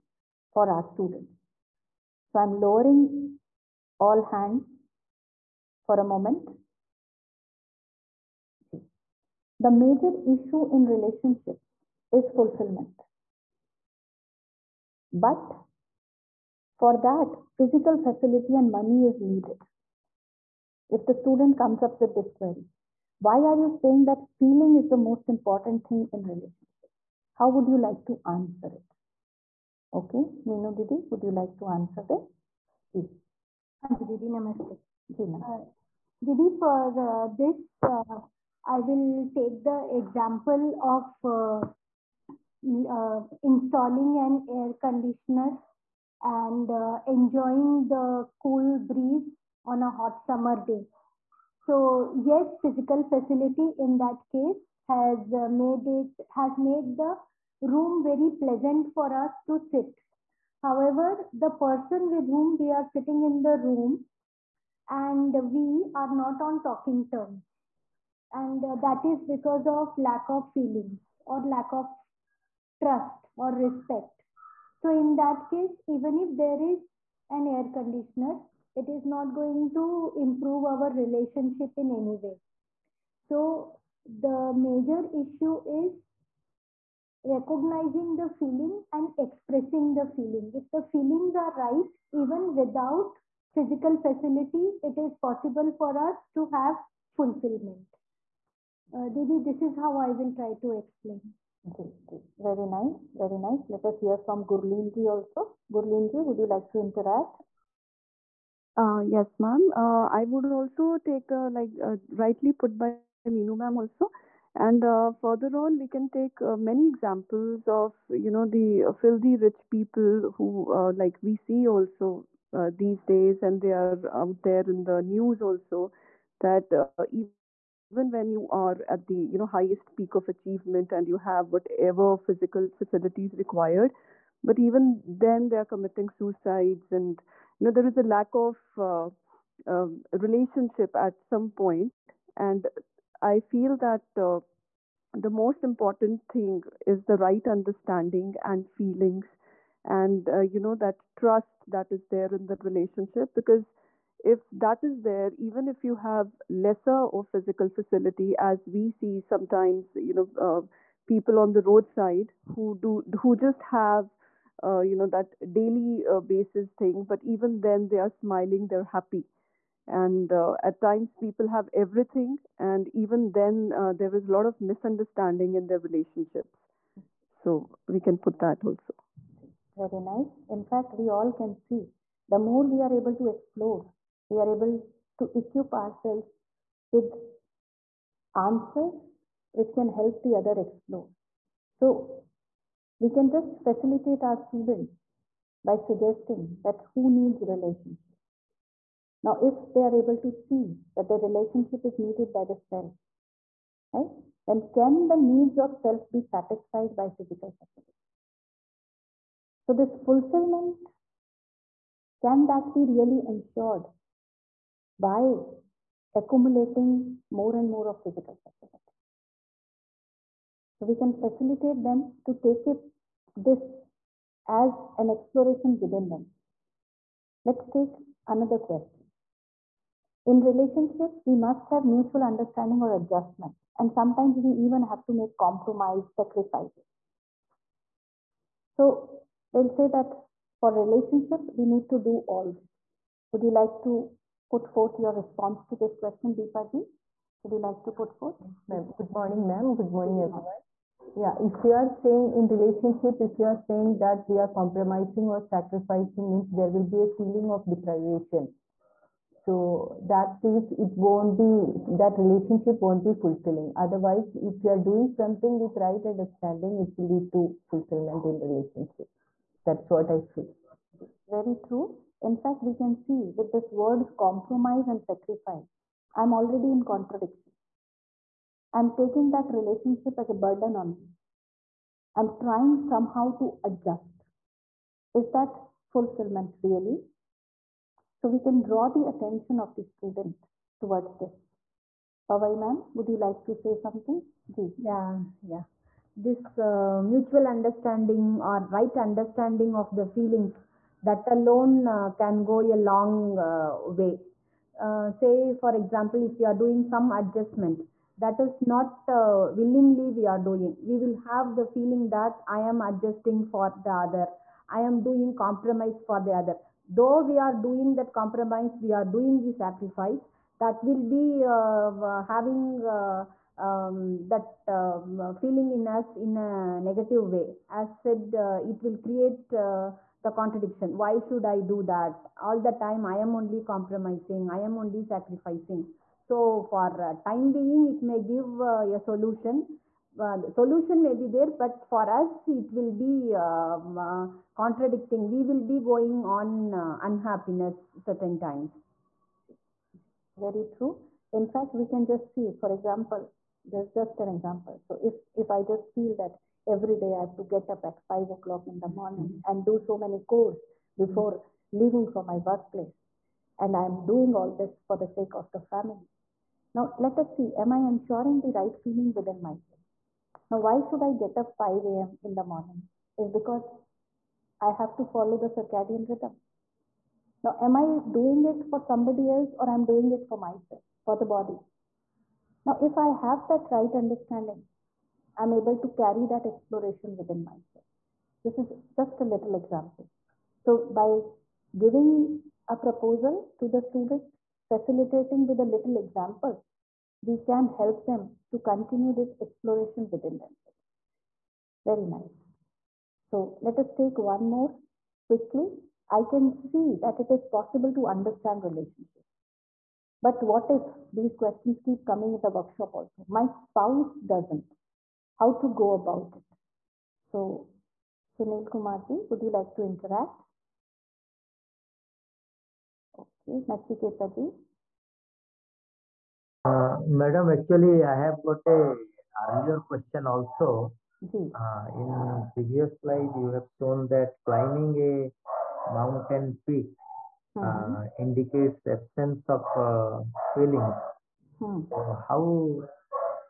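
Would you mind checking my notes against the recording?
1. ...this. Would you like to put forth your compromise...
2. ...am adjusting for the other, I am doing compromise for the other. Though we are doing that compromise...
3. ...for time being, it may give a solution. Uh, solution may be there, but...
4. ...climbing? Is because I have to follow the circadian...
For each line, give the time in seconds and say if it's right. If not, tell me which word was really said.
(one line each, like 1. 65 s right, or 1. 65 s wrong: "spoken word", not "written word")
1. 242 s wrong: "response", not "compromise"
2. 312 s right
3. 336 s right
4. 372 s wrong: "morning", not "climbing".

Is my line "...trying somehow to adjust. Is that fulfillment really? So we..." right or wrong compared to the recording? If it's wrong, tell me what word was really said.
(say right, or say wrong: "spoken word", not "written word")
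right.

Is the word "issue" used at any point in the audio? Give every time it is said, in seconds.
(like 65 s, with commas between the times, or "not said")
10 s, 85 s.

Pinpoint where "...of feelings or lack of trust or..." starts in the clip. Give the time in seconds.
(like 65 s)
70 s.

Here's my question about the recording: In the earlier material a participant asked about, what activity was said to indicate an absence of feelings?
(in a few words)
climbing a mountain peak.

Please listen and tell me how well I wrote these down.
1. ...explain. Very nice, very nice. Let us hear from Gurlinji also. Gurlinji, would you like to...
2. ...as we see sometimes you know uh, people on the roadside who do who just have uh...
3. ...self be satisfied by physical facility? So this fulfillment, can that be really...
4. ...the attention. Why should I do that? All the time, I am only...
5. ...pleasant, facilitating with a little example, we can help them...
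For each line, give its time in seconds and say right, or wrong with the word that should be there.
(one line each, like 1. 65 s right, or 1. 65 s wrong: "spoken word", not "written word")
1. 100 s right
2. 158 s right
3. 205 s right
4. 329 s wrong: "contradiction", not "attention"
5. 393 s wrong: "student", not "pleasant".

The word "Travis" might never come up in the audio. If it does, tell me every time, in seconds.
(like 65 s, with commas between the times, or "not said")
not said.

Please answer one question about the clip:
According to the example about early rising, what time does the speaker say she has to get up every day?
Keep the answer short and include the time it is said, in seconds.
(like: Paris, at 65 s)
5 o'clock, at 358 s.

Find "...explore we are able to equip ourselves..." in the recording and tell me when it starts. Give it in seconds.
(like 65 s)
183 s.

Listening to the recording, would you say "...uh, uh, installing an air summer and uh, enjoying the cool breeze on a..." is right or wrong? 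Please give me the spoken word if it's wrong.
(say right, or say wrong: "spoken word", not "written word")
wrong: "conditioner", not "summer".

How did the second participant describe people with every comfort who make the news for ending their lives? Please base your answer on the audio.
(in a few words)
filthy rich people.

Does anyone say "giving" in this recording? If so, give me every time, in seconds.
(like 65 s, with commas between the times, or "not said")
391 s.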